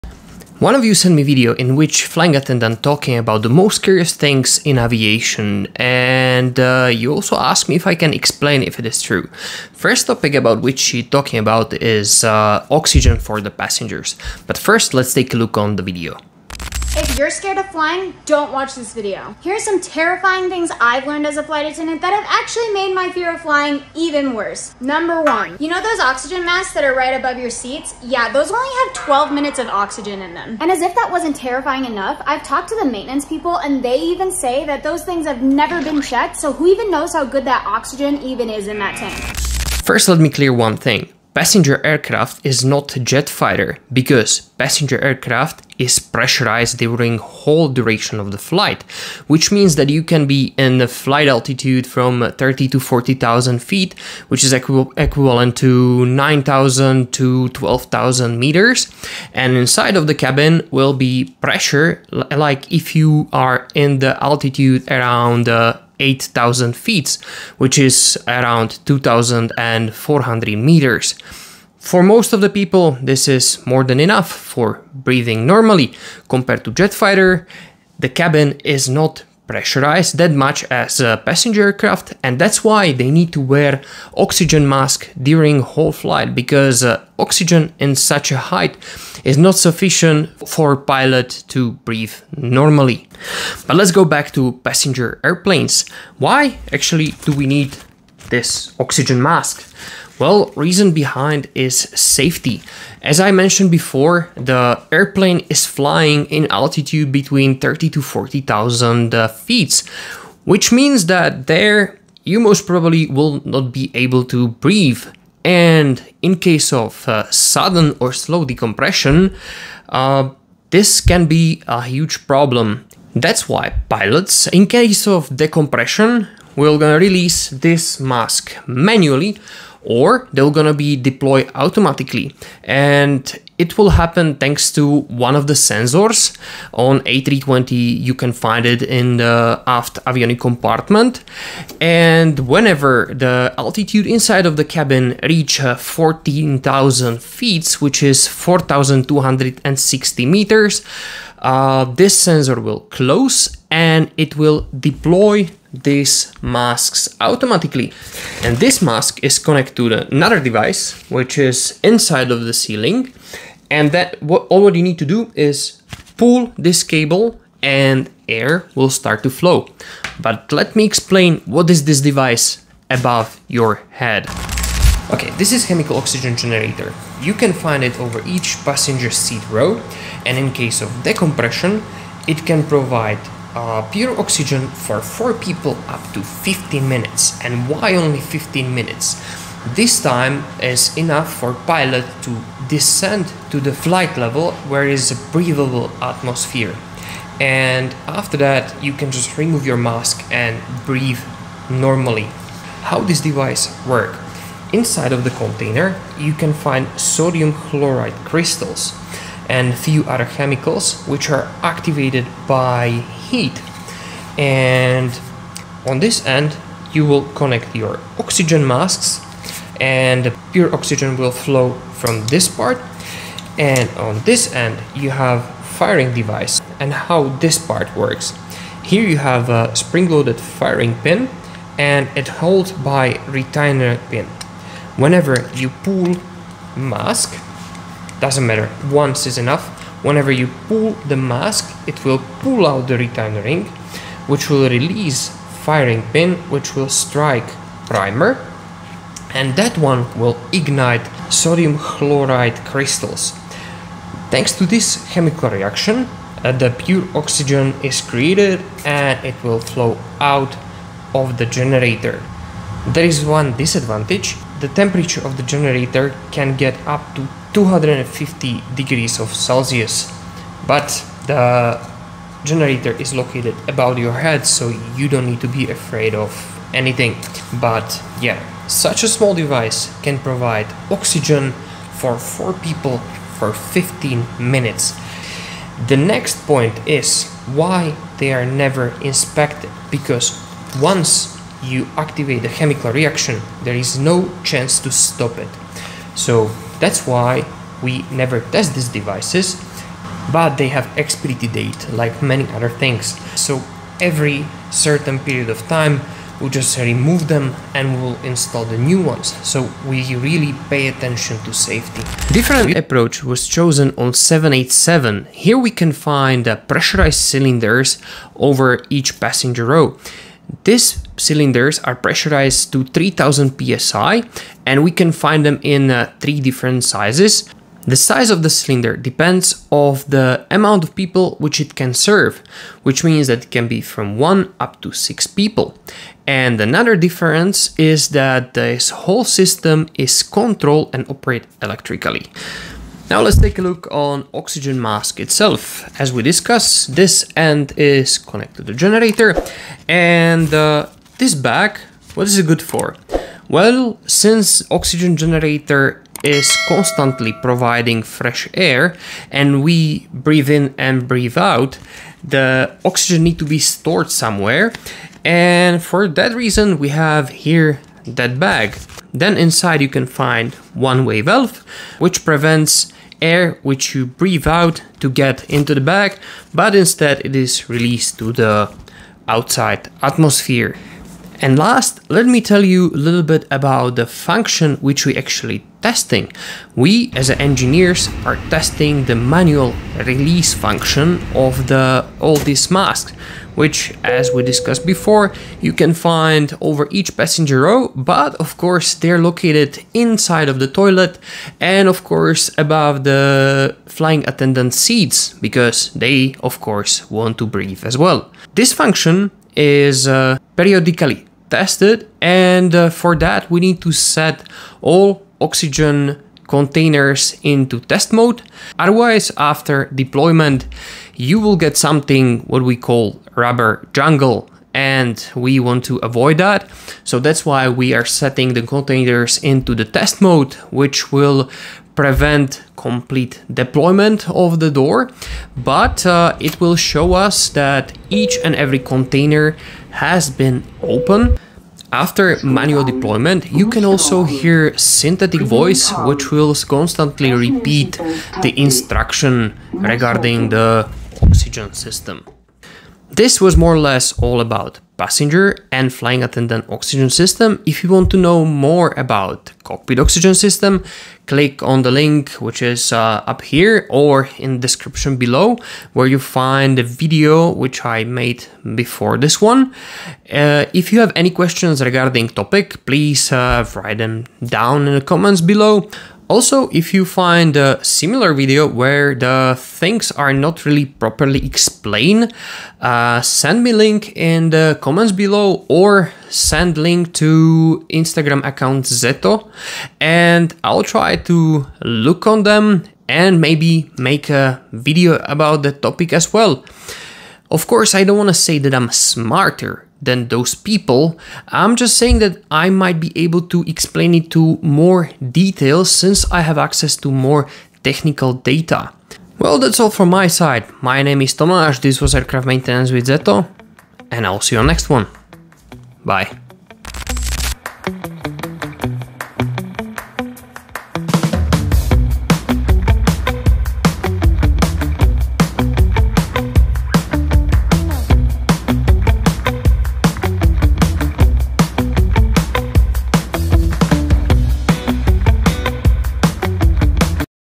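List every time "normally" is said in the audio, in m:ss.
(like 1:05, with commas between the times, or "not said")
1:15, 1:32, 3:21.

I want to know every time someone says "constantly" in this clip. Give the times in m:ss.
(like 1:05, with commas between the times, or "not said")
5:56, 7:26.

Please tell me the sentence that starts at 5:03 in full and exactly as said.
So every certain period of time, we just remove them and we'll install the new ones.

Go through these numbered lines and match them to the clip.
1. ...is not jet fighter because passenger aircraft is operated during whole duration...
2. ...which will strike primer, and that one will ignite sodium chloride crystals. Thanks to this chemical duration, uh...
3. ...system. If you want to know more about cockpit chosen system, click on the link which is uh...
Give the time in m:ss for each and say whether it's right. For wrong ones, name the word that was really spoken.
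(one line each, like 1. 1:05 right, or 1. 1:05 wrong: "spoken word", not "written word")
1. 0:42 wrong: "pressurized", not "operated"
2. 4:06 wrong: "reaction", not "duration"
3. 7:37 wrong: "oxygen", not "chosen".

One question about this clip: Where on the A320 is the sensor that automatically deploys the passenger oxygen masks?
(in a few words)
aft avionic compartment.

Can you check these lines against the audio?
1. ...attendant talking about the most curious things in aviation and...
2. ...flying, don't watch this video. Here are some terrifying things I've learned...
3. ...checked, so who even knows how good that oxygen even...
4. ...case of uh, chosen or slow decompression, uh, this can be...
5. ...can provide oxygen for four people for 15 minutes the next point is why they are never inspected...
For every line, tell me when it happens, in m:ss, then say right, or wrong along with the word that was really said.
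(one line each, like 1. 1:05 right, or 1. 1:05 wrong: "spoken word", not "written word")
1. 0:02 right
2. 0:17 right
3. 0:36 right
4. 1:56 wrong: "sudden", not "chosen"
5. 4:40 right.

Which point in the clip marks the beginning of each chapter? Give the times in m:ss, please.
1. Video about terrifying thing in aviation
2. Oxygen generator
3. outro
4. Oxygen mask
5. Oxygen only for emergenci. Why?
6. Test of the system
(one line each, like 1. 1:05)
1. 0:16
2. 2:54
3. 8:30
4. 5:43
5. 0:39
6. 6:21.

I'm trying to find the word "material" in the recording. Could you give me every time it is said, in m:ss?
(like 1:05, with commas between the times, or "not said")
not said.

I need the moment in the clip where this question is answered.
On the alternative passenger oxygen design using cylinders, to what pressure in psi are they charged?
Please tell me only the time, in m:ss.
5:22.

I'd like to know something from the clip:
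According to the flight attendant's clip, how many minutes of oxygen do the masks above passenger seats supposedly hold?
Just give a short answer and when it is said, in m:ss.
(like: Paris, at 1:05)
12 minutes, at 0:28.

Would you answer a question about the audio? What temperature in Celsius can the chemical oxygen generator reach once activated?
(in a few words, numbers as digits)
250 degrees.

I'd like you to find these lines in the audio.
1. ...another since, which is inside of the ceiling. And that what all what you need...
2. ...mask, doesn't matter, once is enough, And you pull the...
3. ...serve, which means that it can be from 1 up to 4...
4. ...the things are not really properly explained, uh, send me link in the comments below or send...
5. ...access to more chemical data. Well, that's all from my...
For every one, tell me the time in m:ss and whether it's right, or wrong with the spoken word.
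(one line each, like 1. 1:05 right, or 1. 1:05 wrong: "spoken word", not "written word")
1. 2:40 wrong: "device", not "since"
2. 3:56 wrong: "Whenever", not "And"
3. 5:31 wrong: "6", not "4"
4. 7:59 right
5. 8:26 wrong: "technical", not "chemical".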